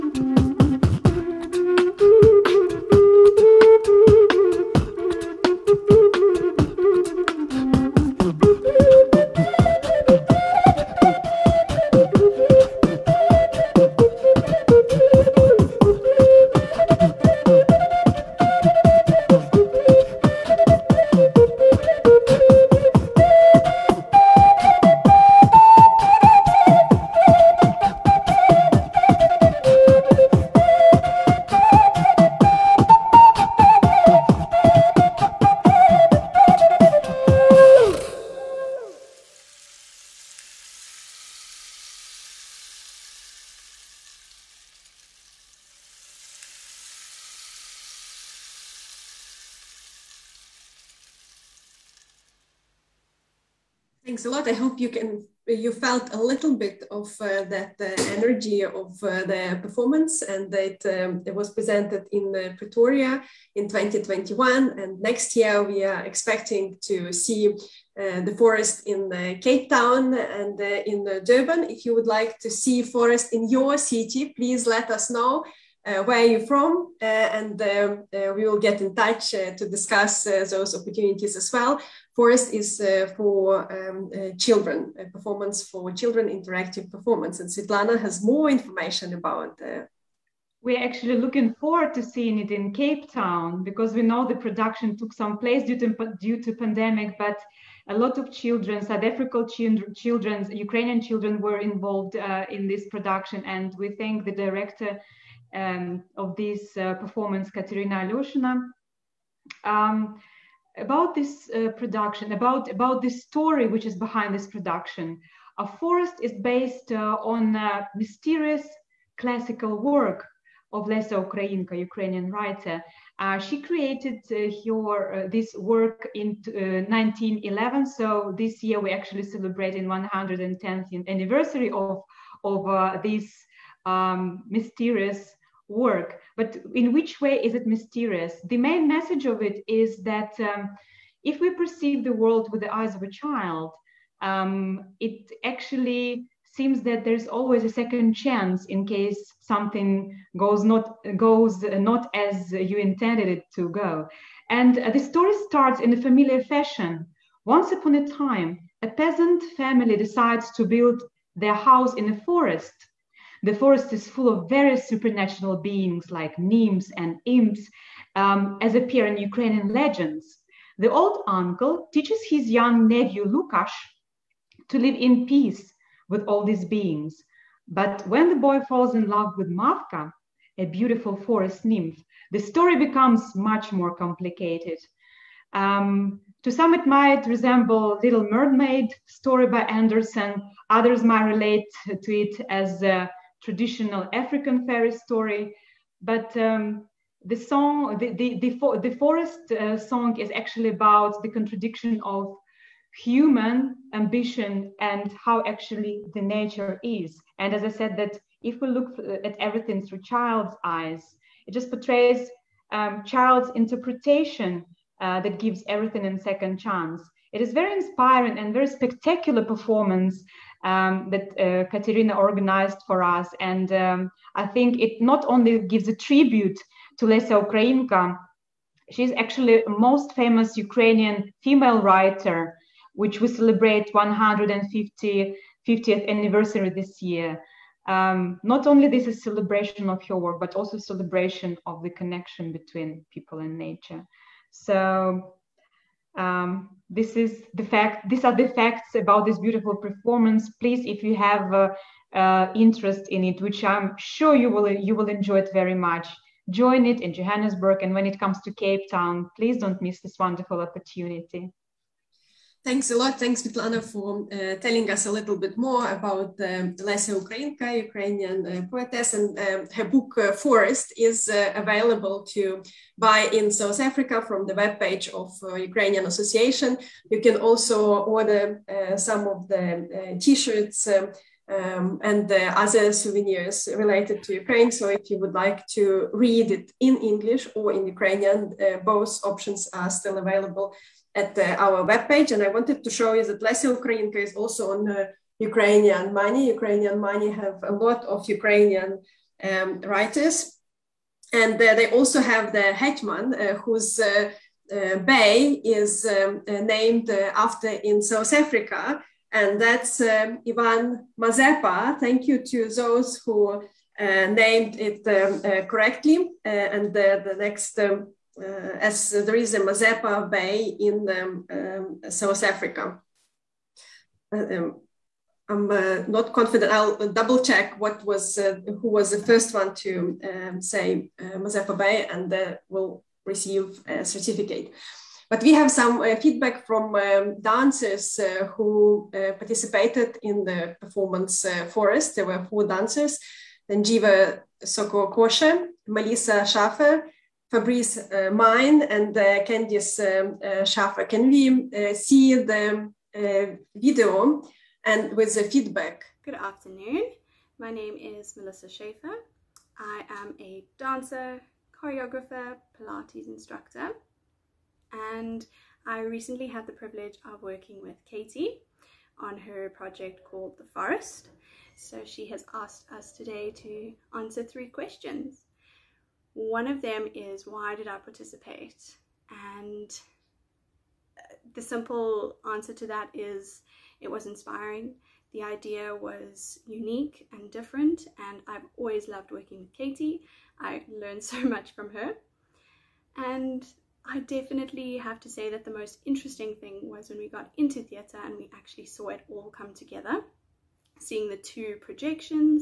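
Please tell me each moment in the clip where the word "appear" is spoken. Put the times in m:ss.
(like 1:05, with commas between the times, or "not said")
2:48.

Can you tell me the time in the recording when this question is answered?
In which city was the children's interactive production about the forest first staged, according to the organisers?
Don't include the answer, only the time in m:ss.
1:02.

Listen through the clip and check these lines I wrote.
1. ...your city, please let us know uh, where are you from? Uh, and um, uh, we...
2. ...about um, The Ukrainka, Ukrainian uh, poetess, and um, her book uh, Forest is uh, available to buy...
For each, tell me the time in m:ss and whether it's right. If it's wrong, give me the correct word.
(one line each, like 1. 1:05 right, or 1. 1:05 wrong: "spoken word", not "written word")
1. 1:13 right
2. 4:25 wrong: "Lesya", not "The".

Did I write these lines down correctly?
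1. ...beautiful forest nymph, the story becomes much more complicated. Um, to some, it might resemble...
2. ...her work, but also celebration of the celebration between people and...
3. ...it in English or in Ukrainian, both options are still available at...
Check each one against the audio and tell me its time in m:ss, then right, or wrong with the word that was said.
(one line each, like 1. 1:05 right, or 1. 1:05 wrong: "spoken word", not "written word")
1. 3:00 right
2. 4:00 wrong: "connection", not "celebration"
3. 4:46 right.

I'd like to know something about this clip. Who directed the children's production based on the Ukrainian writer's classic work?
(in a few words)
Kateryna Aloshyna.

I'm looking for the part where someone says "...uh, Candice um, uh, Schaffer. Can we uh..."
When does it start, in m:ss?
5:49.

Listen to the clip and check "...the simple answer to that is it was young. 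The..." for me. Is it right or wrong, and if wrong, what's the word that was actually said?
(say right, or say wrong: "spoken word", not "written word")
wrong: "inspiring", not "young".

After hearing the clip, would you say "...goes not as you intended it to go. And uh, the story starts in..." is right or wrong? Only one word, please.
right.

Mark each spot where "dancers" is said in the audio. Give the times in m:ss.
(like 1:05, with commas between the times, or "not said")
5:37, 5:42, 6:00.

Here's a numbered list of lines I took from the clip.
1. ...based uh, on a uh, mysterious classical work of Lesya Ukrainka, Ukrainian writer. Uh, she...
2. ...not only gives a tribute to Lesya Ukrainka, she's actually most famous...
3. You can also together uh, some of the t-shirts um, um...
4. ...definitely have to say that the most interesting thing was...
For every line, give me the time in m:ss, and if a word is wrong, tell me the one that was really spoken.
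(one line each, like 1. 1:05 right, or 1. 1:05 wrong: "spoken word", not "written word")
1. 1:56 right
2. 3:45 right
3. 4:37 wrong: "order", not "together"
4. 6:34 right.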